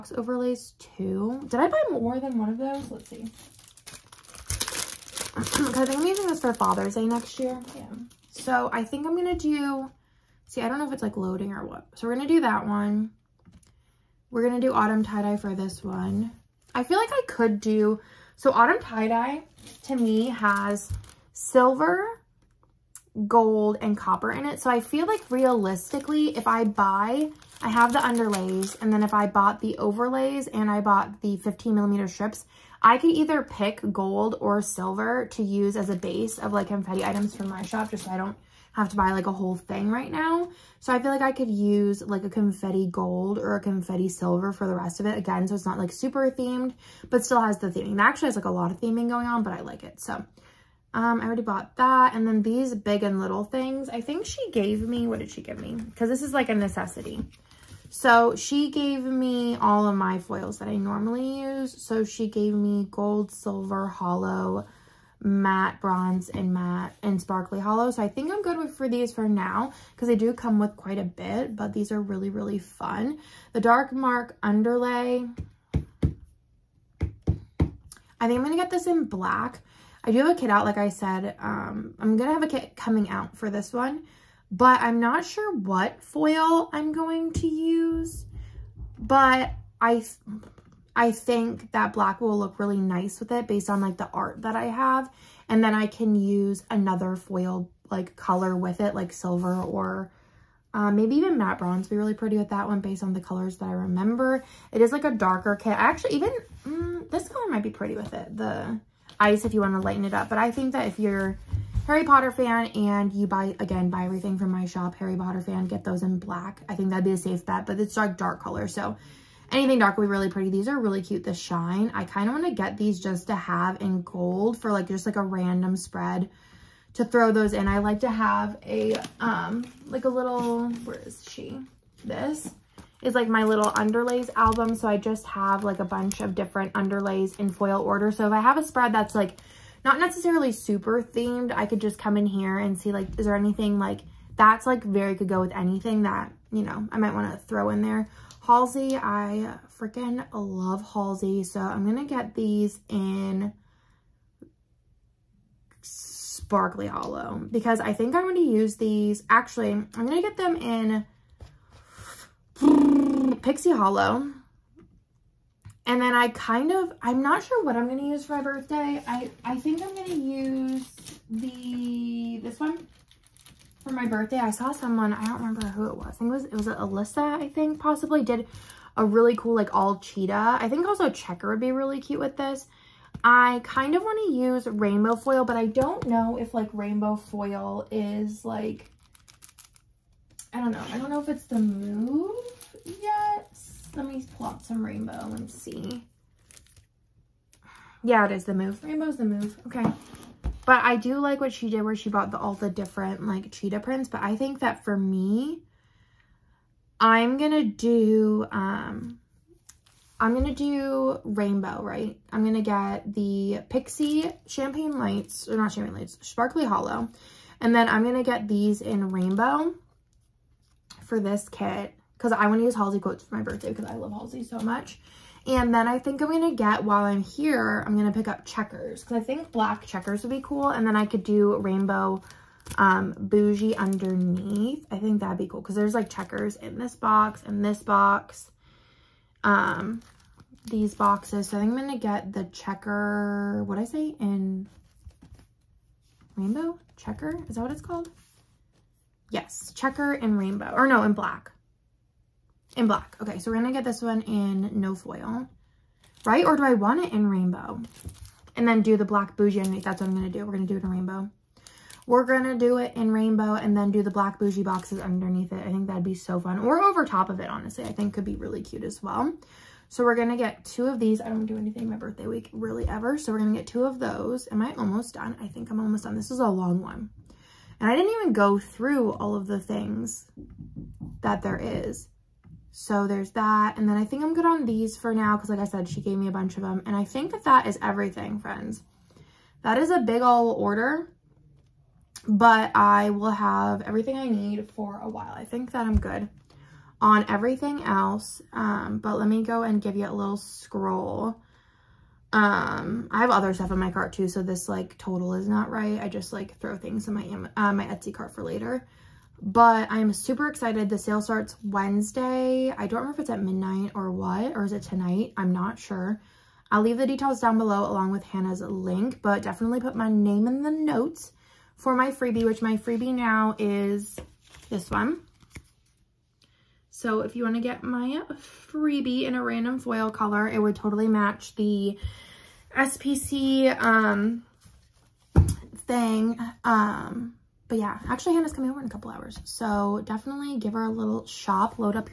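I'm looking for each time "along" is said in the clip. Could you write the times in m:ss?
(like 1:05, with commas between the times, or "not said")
5:17.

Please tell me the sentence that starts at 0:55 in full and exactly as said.
Cause this is like a necessity.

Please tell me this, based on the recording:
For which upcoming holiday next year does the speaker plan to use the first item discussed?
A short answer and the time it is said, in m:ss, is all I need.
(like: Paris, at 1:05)
Father's Day, at 0:06.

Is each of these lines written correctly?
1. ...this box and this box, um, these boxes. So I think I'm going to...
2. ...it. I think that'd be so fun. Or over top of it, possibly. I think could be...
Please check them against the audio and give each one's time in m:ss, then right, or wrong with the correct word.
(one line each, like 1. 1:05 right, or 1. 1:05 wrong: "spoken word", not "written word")
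1. 3:56 right
2. 4:25 wrong: "honestly", not "possibly".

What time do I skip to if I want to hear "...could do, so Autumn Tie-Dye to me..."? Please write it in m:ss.
0:17.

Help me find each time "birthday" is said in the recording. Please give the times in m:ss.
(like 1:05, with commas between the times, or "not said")
2:48, 2:54, 3:43, 4:31.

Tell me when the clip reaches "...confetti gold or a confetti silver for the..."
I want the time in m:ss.
0:42.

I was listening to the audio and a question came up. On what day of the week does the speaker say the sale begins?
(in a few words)
Wednesday.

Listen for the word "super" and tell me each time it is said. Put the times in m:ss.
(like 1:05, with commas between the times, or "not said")
0:45, 2:20, 5:10.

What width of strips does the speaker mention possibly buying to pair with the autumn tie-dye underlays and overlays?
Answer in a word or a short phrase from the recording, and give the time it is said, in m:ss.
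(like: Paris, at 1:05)
15 millimeter, at 0:31.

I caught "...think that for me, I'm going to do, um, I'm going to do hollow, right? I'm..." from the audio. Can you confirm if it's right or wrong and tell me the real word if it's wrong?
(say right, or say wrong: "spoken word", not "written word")
wrong: "rainbow", not "hollow".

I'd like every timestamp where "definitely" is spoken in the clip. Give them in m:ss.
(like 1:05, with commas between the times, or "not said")
5:19, 5:40.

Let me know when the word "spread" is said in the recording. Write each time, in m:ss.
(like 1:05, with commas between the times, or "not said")
2:05, 2:18.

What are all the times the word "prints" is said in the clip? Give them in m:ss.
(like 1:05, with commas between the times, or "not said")
3:23.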